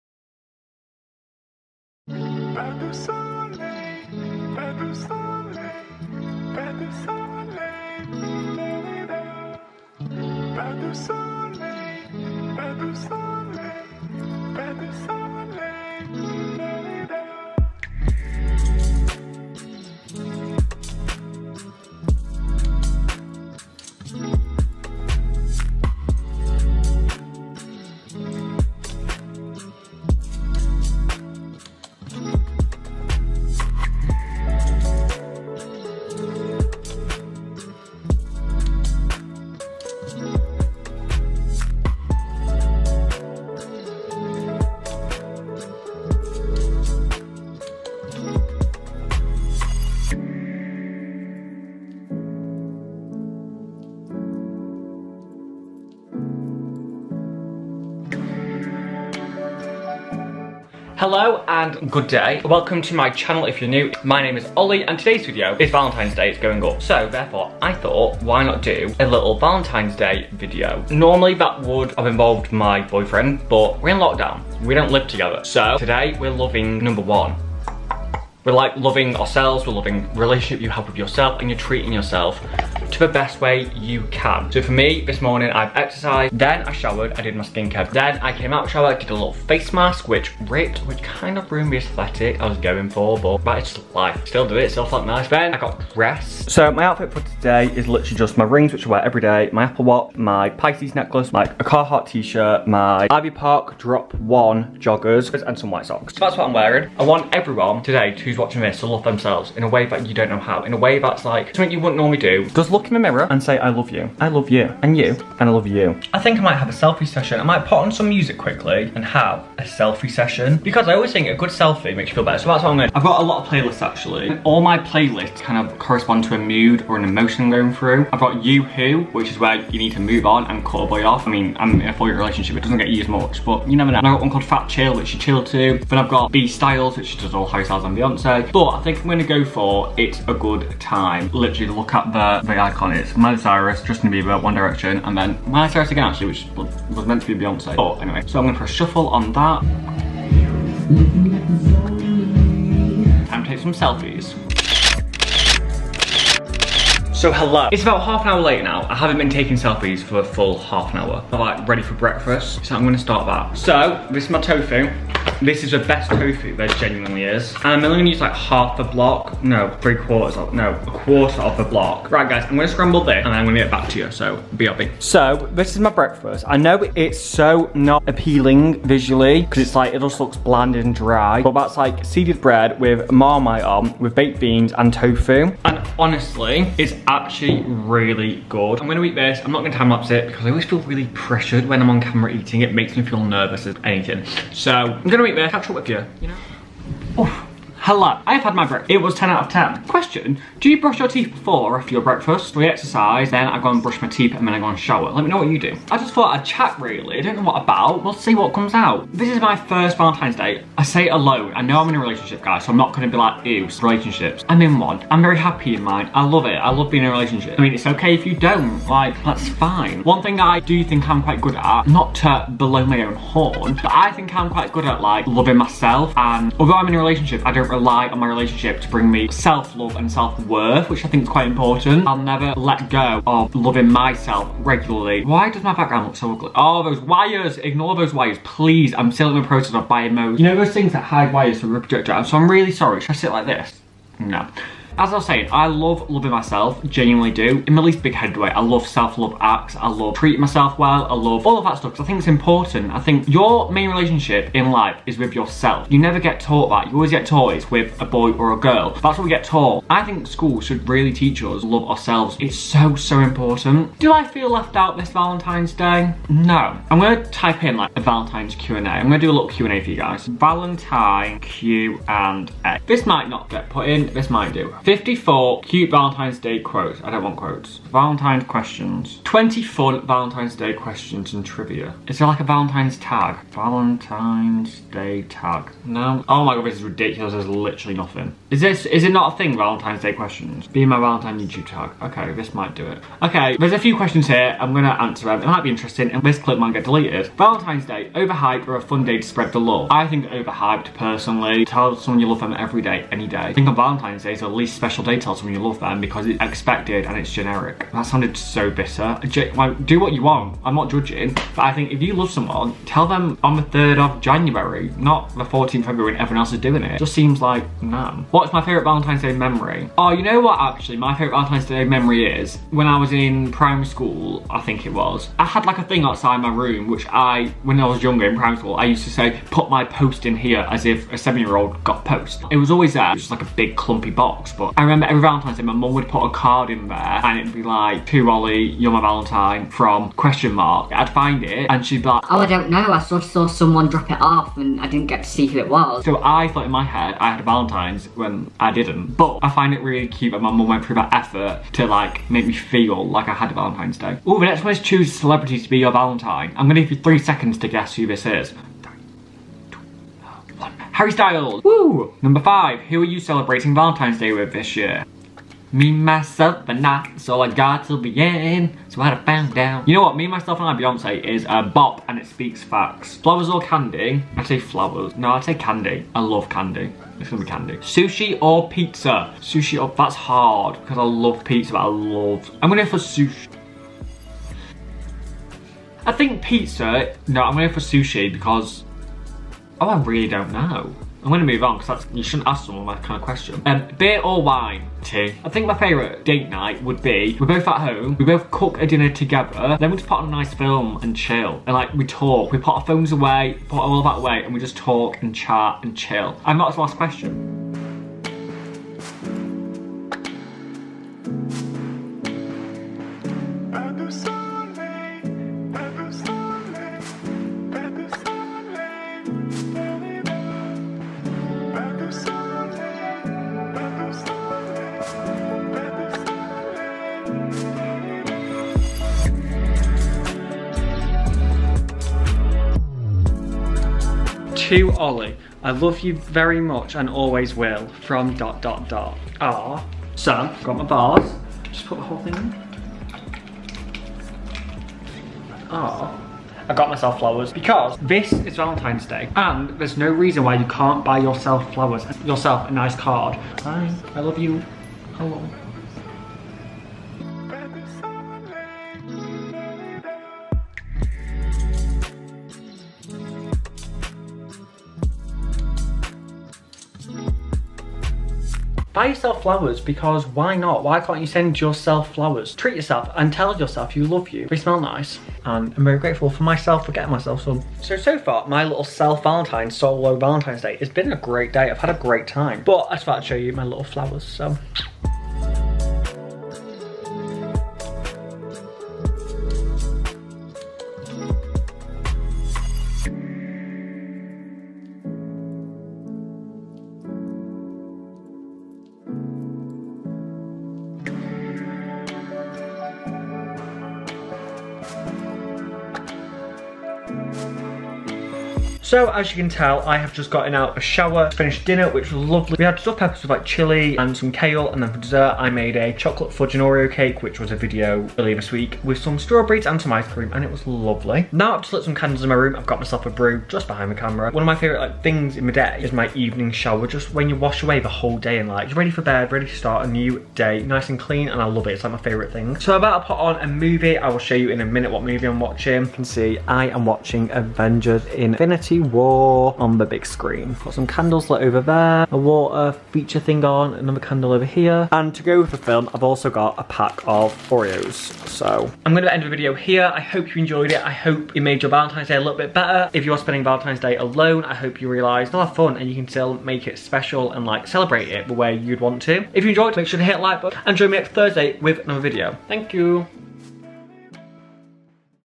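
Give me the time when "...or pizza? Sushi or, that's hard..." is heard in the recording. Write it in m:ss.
6:18.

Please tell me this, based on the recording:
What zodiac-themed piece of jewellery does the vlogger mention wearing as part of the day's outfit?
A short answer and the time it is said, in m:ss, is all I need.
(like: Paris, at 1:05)
Pisces necklace, at 1:40.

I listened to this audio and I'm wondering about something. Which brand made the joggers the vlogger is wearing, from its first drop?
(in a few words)
Ivy Park.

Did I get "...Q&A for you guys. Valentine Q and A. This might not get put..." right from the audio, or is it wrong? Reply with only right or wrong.
right.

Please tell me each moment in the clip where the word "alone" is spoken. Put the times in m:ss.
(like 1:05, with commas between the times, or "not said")
3:31, 9:13.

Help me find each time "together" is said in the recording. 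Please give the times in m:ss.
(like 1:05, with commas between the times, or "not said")
1:15, 6:39.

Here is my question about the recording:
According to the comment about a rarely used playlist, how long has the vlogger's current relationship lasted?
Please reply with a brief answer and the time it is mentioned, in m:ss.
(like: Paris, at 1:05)
4 years, at 2:11.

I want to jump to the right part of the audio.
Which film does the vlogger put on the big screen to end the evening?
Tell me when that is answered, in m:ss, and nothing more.
8:57.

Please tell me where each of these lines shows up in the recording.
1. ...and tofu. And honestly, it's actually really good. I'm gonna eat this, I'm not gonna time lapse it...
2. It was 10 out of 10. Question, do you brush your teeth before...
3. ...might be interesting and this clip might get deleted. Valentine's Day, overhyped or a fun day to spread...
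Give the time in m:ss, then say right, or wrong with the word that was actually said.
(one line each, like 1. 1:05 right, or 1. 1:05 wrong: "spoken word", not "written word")
1. 3:04 right
2. 3:18 right
3. 4:55 right.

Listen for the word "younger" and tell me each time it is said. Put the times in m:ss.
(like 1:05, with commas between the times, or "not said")
5:28.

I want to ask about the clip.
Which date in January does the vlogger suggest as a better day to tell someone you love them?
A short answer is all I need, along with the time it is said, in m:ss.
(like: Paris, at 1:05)
3rd of January, at 5:13.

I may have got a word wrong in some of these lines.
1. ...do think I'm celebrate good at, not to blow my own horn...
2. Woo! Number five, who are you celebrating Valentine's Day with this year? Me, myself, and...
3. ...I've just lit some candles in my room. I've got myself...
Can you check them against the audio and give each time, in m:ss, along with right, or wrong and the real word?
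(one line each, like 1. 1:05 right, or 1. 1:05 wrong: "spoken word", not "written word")
1. 3:40 wrong: "quite", not "celebrate"
2. 6:01 right
3. 8:41 right.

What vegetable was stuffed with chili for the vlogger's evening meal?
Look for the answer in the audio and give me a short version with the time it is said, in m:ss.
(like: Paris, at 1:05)
Peppers, at 8:32.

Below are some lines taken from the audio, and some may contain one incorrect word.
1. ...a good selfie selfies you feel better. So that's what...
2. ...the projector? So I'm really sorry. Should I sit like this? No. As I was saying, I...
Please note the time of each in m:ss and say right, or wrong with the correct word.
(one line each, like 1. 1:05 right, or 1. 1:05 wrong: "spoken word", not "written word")
1. 2:01 wrong: "makes", not "selfies"
2. 4:01 right.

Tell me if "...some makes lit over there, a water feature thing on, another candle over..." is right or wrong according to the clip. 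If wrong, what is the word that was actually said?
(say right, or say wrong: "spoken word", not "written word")
wrong: "candles", not "makes".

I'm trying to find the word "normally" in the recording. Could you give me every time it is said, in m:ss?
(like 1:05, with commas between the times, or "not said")
1:10, 1:51.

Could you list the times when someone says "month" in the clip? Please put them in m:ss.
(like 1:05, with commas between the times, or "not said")
not said.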